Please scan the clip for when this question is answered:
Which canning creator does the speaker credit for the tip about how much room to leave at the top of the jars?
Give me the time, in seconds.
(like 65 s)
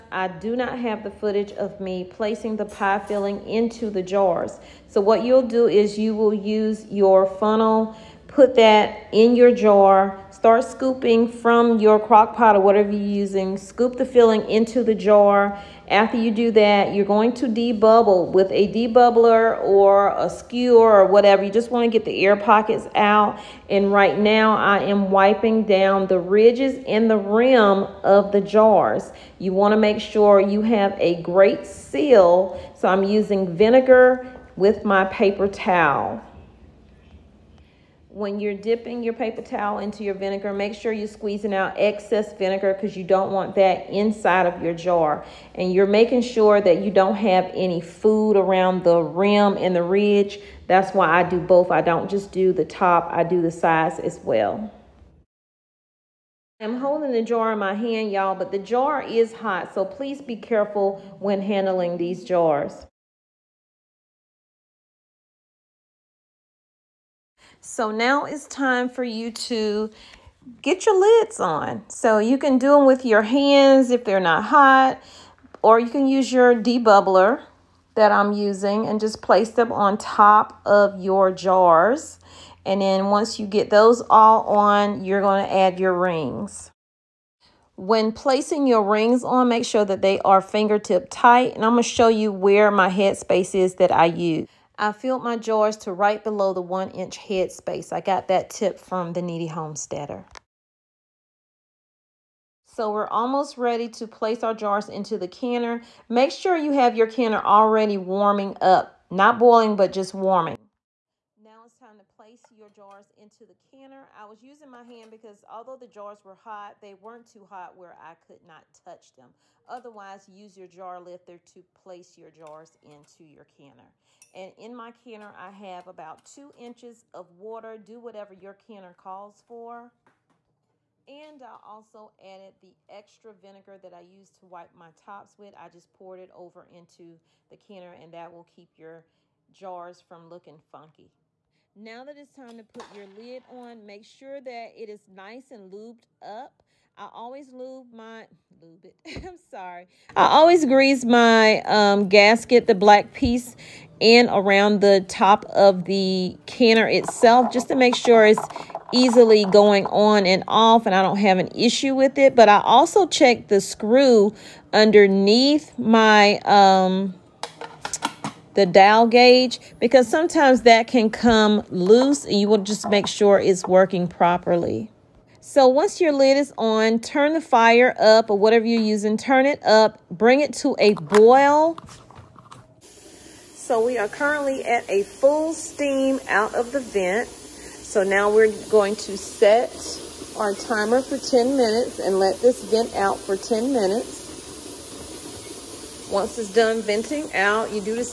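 99 s.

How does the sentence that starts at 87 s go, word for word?
When placing your rings on, make sure that they are fingertip tight.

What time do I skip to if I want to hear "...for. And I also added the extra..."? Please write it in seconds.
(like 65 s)
129 s.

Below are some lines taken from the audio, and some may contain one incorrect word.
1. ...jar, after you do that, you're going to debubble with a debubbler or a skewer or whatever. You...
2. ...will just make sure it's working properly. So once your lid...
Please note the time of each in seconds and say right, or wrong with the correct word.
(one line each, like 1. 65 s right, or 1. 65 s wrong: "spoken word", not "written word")
1. 14 s right
2. 172 s right.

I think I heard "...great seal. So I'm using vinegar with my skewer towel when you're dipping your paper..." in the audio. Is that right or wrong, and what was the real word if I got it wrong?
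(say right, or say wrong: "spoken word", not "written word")
wrong: "paper", not "skewer".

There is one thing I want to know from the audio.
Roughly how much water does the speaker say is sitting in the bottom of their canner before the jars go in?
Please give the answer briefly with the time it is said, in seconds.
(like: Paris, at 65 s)
2 inches, at 126 s.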